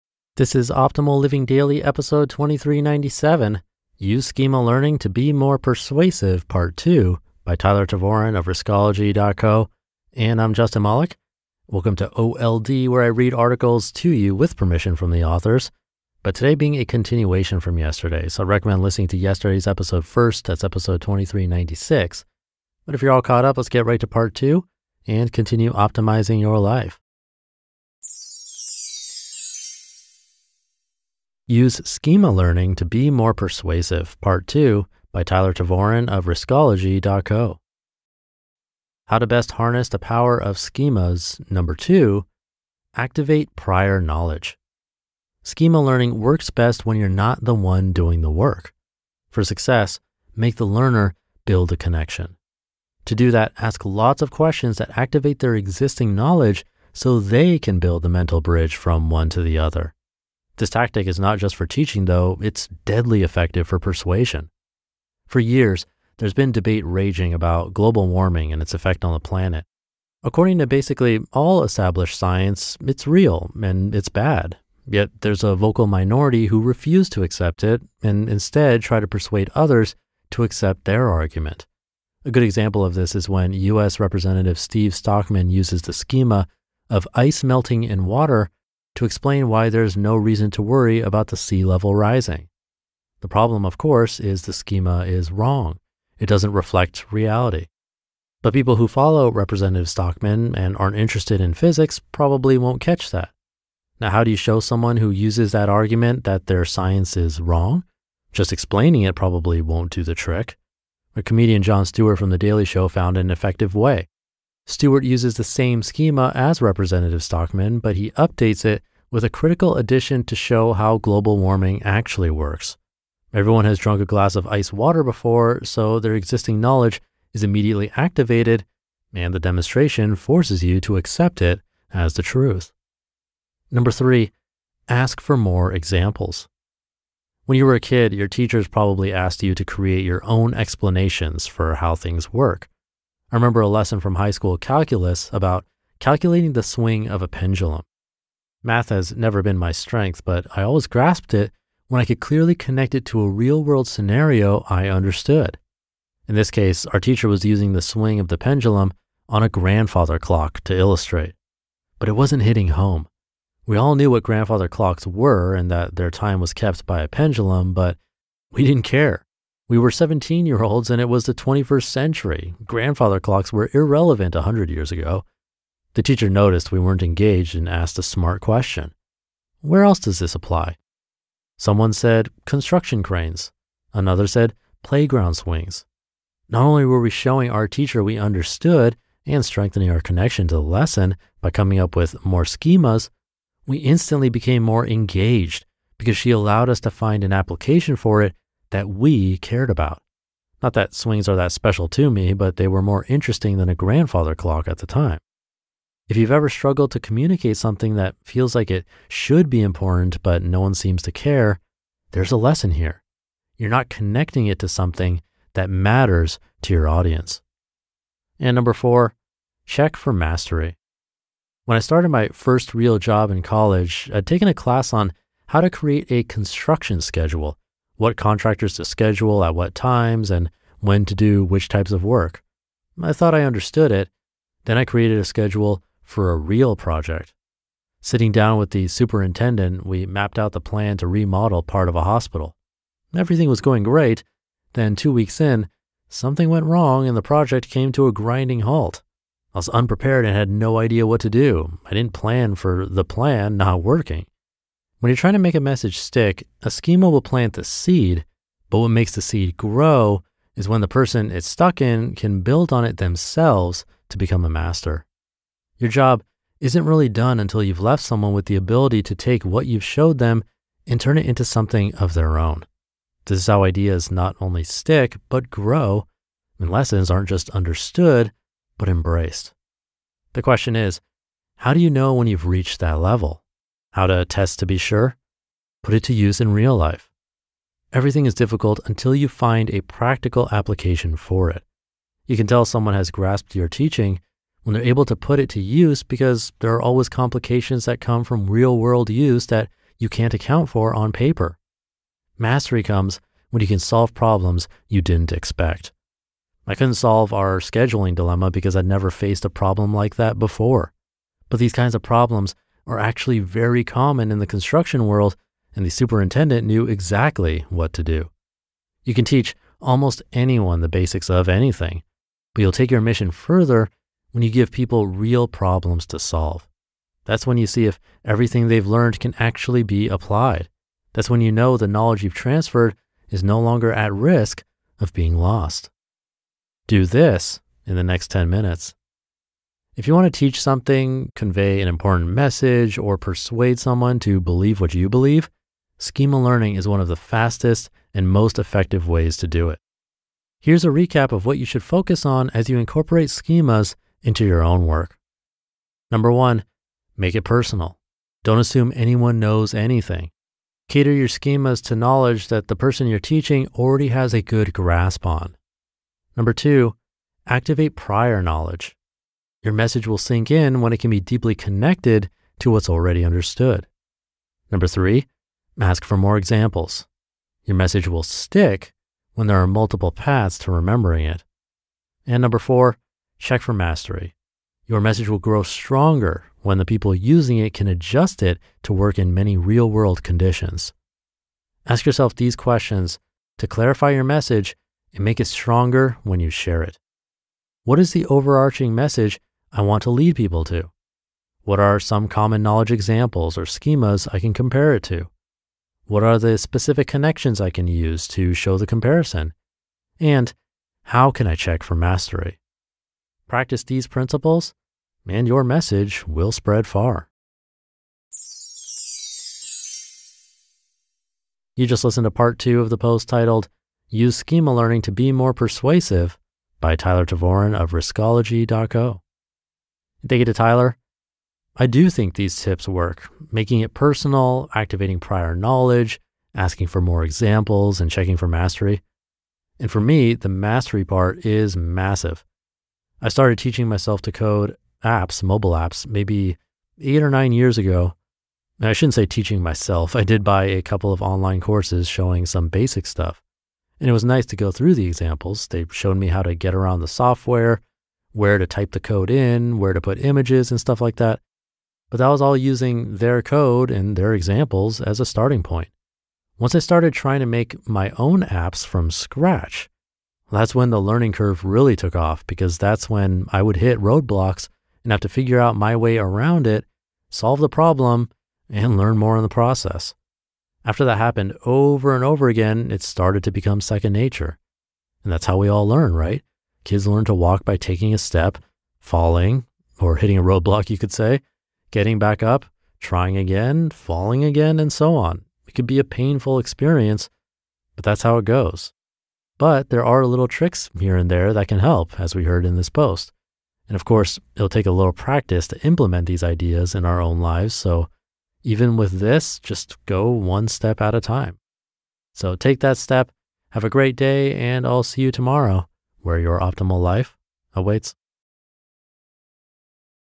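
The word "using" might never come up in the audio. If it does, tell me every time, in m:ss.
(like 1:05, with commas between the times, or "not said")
2:37, 6:27, 7:42.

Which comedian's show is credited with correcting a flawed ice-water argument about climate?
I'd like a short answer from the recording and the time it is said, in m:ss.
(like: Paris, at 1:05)
Jon Stewart, at 1:51.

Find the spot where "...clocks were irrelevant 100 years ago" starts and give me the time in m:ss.
2:53.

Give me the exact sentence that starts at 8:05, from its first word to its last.
And that's how we all learn, right?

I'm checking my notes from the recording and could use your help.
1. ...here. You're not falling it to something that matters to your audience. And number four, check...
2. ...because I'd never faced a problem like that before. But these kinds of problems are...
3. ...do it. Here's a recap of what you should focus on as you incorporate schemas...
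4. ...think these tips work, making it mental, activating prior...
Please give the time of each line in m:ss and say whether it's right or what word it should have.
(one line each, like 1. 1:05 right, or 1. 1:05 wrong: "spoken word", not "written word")
1. 3:32 wrong: "connecting", not "falling"
2. 5:08 right
3. 5:49 right
4. 7:12 wrong: "personal", not "mental".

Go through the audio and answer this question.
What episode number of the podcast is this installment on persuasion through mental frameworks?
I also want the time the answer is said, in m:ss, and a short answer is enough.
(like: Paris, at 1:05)
2397, at 0:01.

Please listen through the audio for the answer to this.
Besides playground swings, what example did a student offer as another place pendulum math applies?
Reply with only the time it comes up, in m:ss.
3:02.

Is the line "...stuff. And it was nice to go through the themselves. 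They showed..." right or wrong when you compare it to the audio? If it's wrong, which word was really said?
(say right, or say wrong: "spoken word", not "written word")
wrong: "examples", not "themselves".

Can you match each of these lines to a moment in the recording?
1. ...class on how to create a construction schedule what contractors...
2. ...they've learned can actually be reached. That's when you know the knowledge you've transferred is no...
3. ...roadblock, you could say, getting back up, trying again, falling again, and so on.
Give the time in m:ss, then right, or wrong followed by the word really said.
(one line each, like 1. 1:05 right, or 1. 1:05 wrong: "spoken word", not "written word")
1. 3:44 right
2. 5:28 wrong: "applied", not "reached"
3. 8:10 right.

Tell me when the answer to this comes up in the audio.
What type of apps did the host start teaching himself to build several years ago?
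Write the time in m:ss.
7:25.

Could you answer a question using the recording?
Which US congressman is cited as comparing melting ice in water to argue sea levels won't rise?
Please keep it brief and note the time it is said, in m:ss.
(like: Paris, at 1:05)
Steve Stockman, at 1:24.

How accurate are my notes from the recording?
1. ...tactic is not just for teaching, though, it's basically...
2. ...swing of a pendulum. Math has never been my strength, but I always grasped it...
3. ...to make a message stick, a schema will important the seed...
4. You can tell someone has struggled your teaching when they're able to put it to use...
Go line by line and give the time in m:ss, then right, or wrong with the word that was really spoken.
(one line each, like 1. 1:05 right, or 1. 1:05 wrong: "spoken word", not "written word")
1. 1:00 wrong: "deadly", not "basically"
2. 2:26 right
3. 4:15 wrong: "plant", not "important"
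4. 4:52 wrong: "grasped", not "struggled".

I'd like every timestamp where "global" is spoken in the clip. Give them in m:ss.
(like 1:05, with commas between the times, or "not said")
1:07, 2:00.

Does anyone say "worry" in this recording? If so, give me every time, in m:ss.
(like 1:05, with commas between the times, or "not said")
1:30.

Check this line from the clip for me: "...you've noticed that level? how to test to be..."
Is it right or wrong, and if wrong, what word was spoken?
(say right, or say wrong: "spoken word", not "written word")
wrong: "reached", not "noticed".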